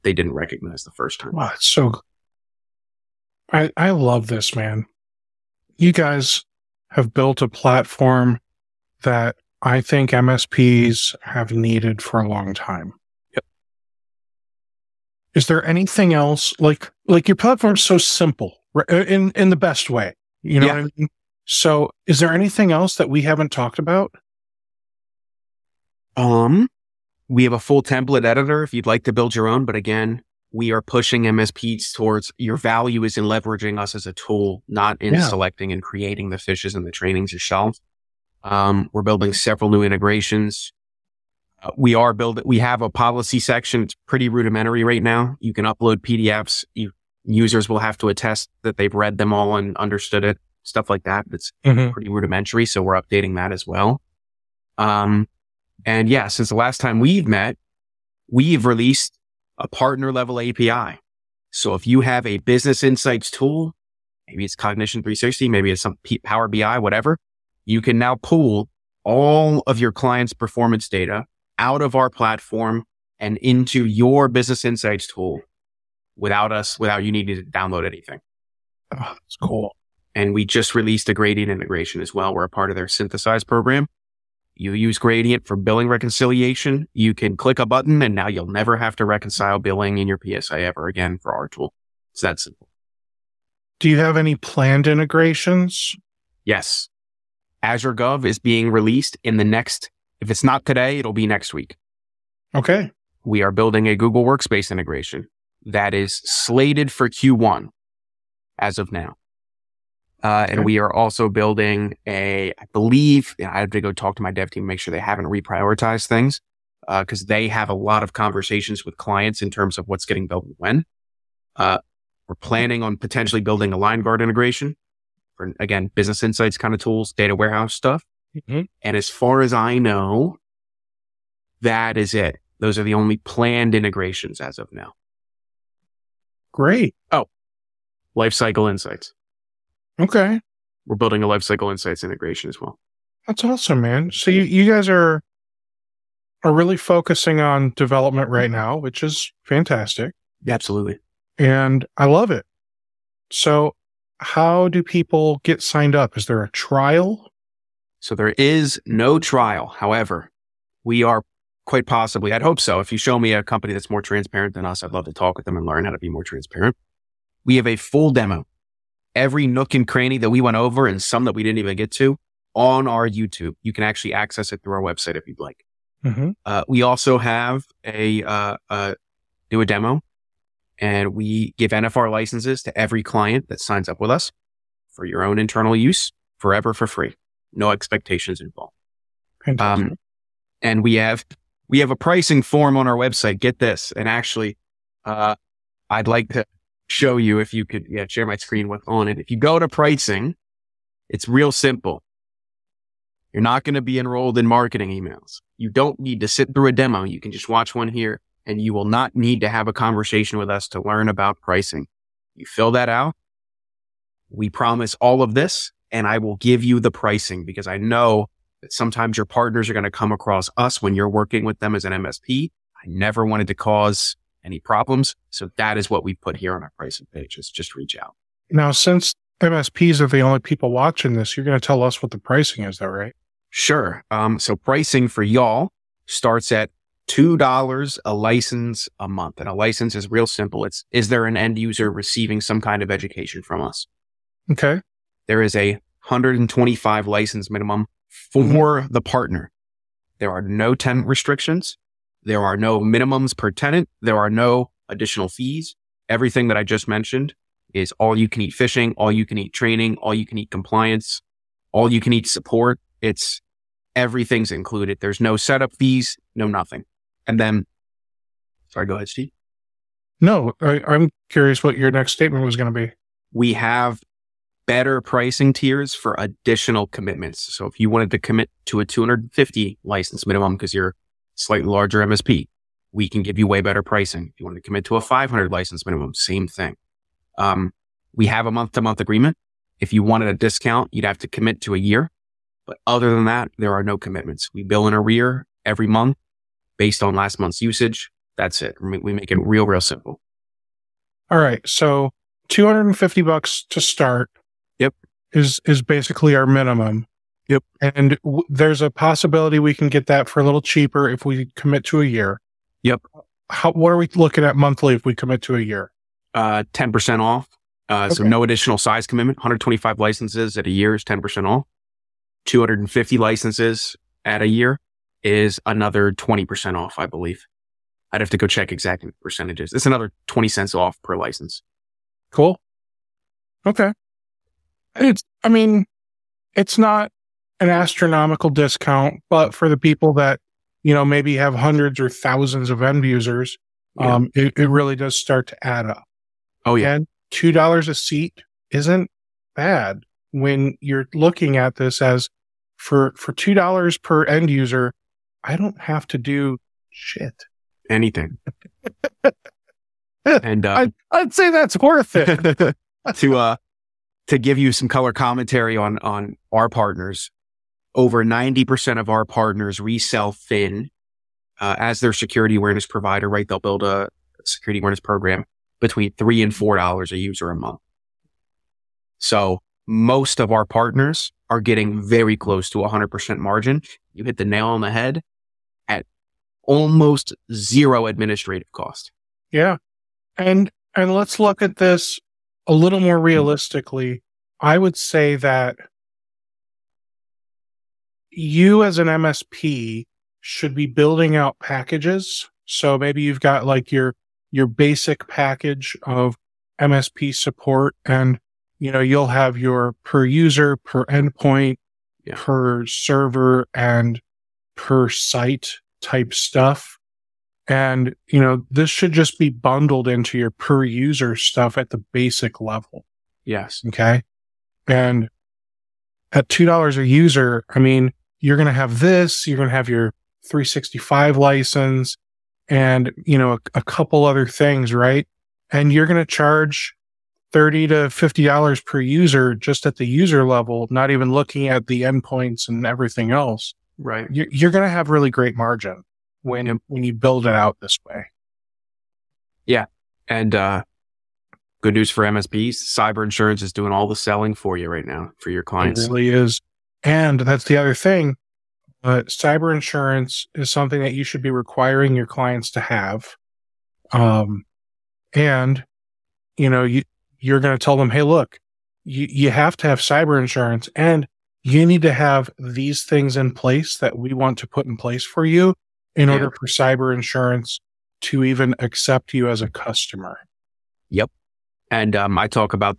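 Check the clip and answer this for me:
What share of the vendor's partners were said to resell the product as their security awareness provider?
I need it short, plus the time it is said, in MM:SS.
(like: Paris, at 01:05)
Over 90%, at 06:07.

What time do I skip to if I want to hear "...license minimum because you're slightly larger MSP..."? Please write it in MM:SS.
04:39.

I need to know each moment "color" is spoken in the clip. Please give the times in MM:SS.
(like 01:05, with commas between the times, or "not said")
06:04.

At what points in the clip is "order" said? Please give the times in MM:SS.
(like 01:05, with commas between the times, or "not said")
07:56.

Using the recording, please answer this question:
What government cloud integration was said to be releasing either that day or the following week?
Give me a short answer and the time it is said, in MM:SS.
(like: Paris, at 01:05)
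Azure Gov, at 01:37.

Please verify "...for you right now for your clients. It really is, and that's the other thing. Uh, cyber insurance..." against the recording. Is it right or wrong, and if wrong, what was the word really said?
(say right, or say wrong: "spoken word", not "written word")
right.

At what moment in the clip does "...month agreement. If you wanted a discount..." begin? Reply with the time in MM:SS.
04:48.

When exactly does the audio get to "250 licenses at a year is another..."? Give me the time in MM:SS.
05:22.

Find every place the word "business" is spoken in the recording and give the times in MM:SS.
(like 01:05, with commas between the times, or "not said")
01:02, 01:14, 02:05.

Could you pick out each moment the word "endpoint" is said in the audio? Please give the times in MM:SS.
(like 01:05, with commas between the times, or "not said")
06:51, 07:22.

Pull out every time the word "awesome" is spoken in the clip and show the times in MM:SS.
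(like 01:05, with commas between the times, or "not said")
02:23.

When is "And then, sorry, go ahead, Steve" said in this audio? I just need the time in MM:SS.
04:27.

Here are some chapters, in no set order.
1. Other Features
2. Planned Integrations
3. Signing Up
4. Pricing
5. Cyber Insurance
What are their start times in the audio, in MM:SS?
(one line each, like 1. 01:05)
1. 00:27
2. 01:33
3. 02:33
4. 03:48
5. 07:36.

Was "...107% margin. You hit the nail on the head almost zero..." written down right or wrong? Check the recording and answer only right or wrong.
wrong.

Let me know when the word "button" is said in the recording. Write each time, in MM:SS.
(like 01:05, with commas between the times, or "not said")
01:27.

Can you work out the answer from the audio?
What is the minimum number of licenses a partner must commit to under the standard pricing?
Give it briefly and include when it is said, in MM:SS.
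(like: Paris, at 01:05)
125, at 04:06.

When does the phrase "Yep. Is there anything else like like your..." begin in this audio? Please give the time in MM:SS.
00:13.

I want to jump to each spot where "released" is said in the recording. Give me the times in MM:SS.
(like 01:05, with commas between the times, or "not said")
00:58, 01:20, 01:38.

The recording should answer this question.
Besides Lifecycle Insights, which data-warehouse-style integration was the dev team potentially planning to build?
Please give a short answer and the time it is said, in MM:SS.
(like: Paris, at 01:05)
Liongard, at 02:03.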